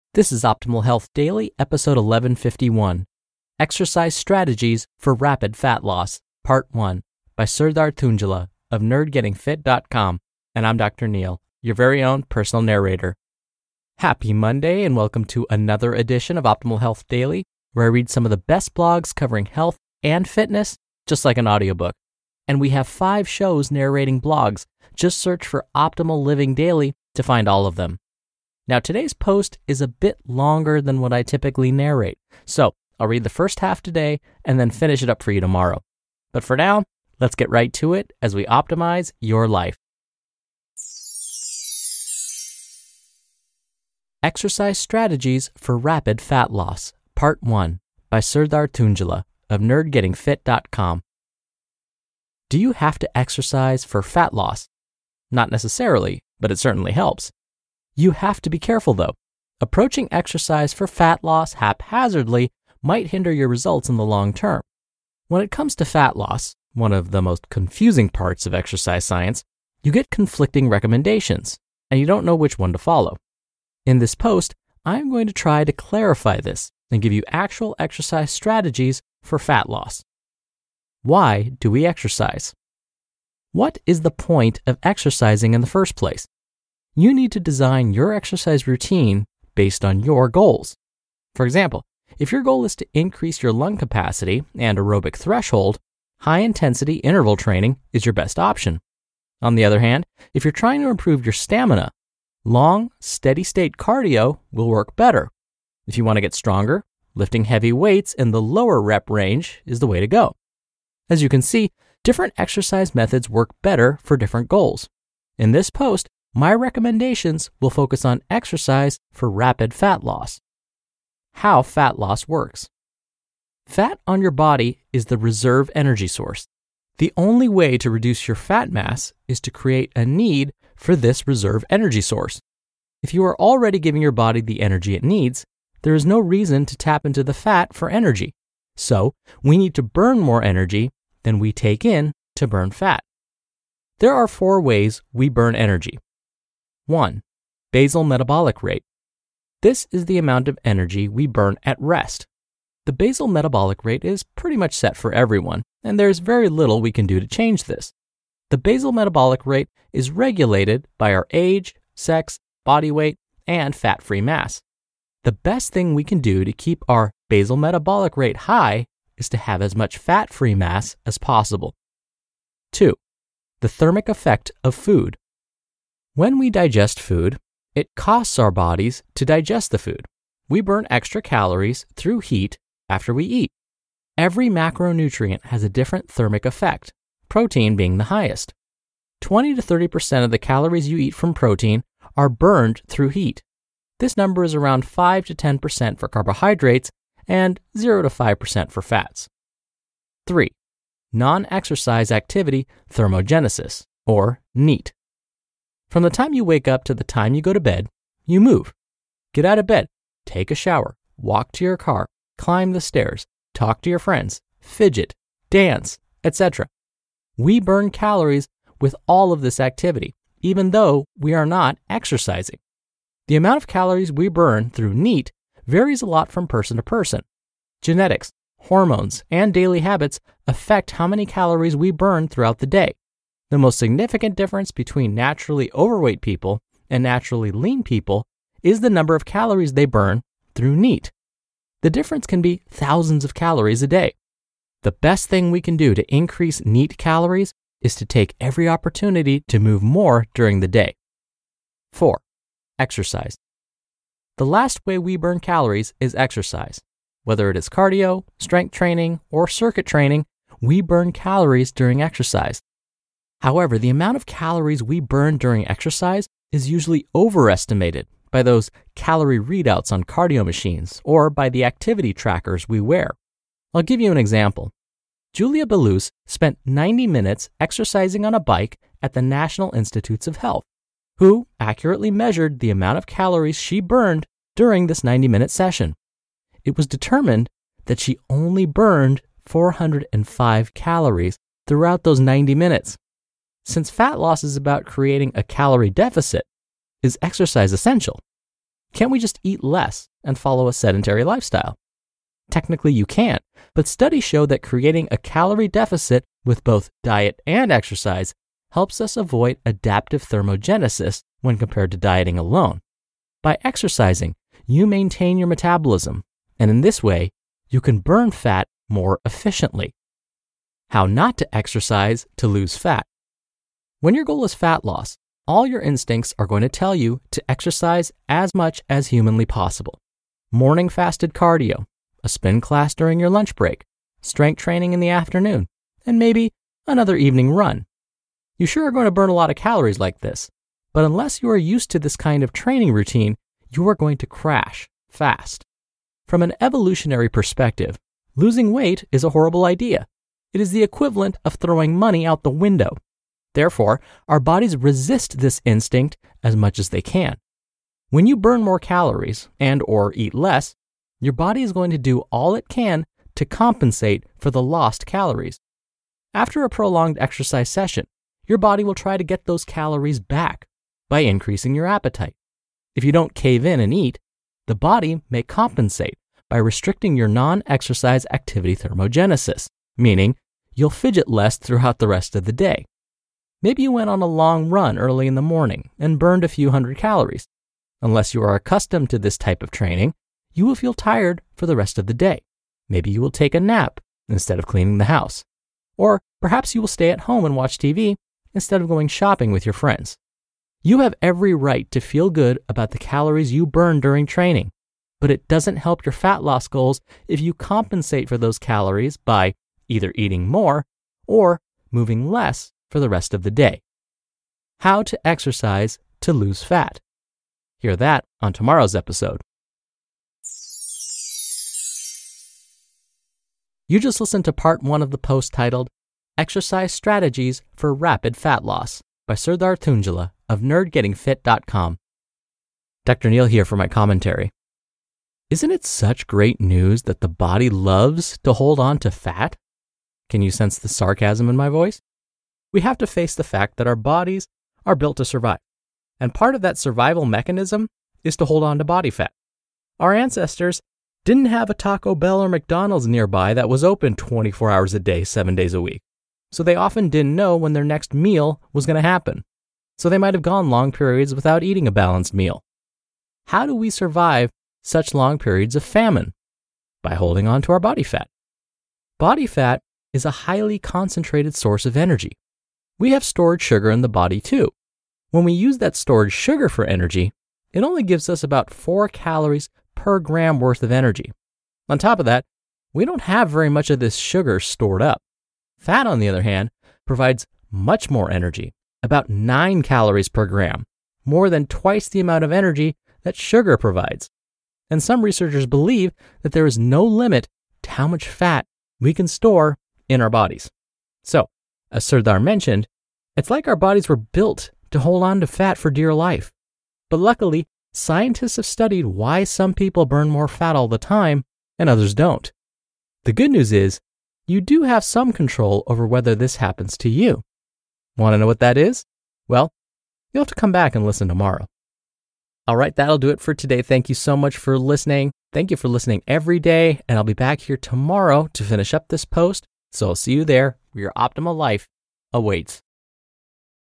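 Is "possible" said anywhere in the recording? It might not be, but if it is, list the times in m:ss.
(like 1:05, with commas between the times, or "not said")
2:51, 5:29.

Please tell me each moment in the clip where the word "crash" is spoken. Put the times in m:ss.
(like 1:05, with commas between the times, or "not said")
5:44.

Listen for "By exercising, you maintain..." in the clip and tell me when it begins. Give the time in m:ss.
5:13.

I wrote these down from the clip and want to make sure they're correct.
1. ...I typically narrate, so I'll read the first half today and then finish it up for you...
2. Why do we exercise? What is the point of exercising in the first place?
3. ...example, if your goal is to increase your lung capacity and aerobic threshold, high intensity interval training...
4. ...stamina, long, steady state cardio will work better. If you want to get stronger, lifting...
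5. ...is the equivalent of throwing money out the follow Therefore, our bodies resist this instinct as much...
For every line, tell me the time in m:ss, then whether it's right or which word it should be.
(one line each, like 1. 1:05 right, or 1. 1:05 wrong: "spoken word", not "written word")
1. 0:31 right
2. 1:21 right
3. 1:31 right
4. 1:41 right
5. 5:50 wrong: "window", not "follow".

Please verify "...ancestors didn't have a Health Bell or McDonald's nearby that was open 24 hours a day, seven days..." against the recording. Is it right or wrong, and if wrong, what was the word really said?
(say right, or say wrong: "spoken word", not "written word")
wrong: "Taco", not "Health".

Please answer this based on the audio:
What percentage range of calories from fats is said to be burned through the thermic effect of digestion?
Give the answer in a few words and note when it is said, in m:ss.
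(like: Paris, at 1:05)
0 to 5%, at 3:17.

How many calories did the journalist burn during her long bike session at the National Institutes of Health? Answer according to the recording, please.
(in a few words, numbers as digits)
405.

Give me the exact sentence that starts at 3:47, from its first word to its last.
Genetics, hormones, and daily habits affect how many calories we burn throughout the day.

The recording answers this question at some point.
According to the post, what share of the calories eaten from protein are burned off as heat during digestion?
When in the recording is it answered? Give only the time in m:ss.
3:09.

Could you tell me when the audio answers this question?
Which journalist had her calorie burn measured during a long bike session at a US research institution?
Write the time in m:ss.
4:35.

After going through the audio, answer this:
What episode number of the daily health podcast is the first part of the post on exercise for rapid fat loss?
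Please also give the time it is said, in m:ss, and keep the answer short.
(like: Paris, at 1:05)
1151, at 0:01.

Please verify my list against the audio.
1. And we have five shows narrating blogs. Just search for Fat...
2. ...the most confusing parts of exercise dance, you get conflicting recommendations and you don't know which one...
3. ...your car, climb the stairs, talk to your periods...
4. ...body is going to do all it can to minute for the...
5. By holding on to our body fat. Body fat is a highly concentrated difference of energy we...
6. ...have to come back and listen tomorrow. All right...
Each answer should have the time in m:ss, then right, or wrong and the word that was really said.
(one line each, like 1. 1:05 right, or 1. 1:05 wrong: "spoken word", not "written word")
1. 0:22 wrong: "Optimal", not "Fat"
2. 1:07 wrong: "science", not "dance"
3. 3:31 wrong: "friends", not "periods"
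4. 6:01 wrong: "compensate", not "minute"
5. 7:47 wrong: "source", not "difference"
6. 8:40 right.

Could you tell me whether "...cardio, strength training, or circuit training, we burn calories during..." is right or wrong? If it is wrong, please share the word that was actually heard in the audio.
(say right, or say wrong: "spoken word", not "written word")
right.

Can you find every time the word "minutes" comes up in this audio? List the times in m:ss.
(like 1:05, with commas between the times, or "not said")
4:37, 4:45, 4:52.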